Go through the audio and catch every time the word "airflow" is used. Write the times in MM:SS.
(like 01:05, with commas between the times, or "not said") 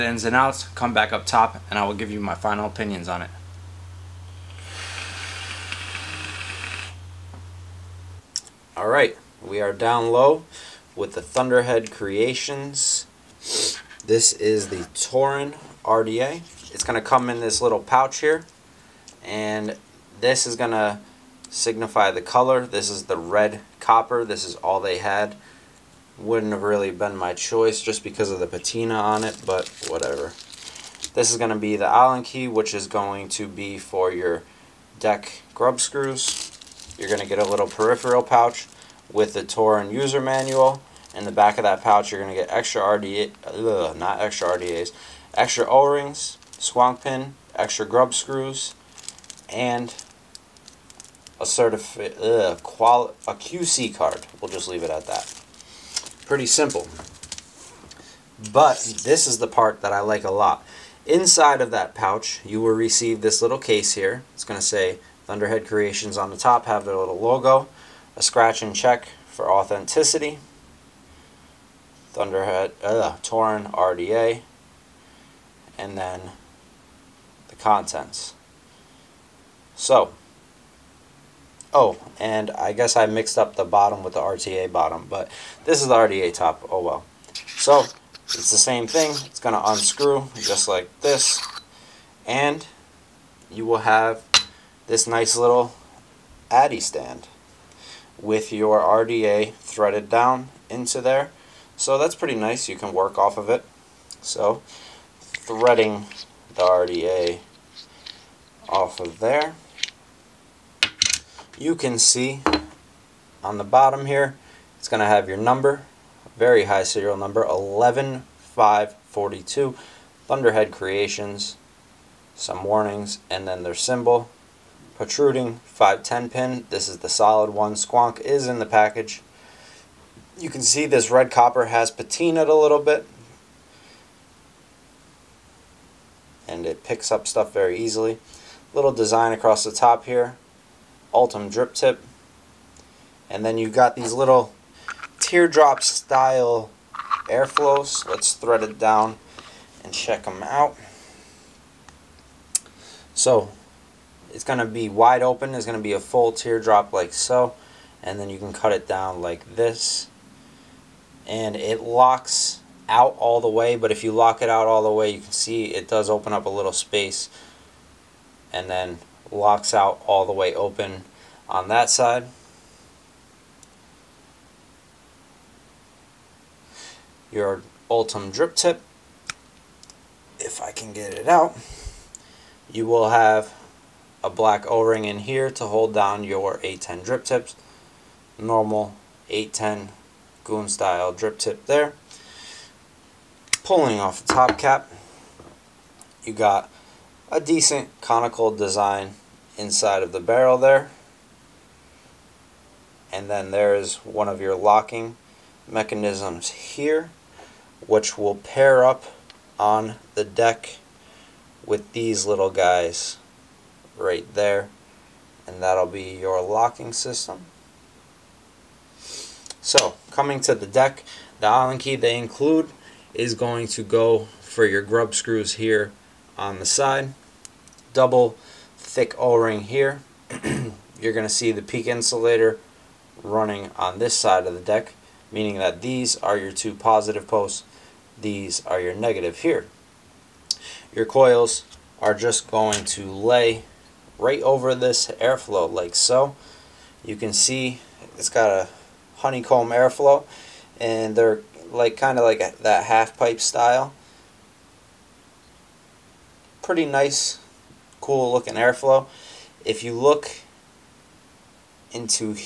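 02:27, 04:05, 04:09, 04:18.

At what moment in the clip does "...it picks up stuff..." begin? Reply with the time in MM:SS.
02:16.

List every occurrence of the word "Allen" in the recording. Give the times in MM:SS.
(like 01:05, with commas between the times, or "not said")
00:31, 03:41.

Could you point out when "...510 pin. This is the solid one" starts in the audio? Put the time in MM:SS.
02:05.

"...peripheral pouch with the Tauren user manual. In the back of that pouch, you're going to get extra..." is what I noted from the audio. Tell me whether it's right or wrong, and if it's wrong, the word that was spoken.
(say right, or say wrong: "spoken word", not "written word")
right.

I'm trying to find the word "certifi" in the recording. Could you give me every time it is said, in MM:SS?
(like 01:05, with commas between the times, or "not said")
00:51.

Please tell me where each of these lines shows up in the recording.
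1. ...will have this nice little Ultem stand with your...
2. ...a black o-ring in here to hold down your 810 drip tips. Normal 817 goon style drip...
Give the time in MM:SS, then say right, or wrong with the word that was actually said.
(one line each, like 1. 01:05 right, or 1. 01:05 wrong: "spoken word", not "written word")
1. 01:33 wrong: "Addy", not "Ultem"
2. 03:04 wrong: "810", not "817".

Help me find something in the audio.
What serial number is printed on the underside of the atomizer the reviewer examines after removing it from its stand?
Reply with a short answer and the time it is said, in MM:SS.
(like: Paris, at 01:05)
11542, at 01:57.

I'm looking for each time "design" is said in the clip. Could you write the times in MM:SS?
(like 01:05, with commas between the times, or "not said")
02:18, 03:18.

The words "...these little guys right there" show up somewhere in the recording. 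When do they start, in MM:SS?
03:31.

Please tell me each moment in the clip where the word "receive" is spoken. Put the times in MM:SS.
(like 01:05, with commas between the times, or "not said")
01:02.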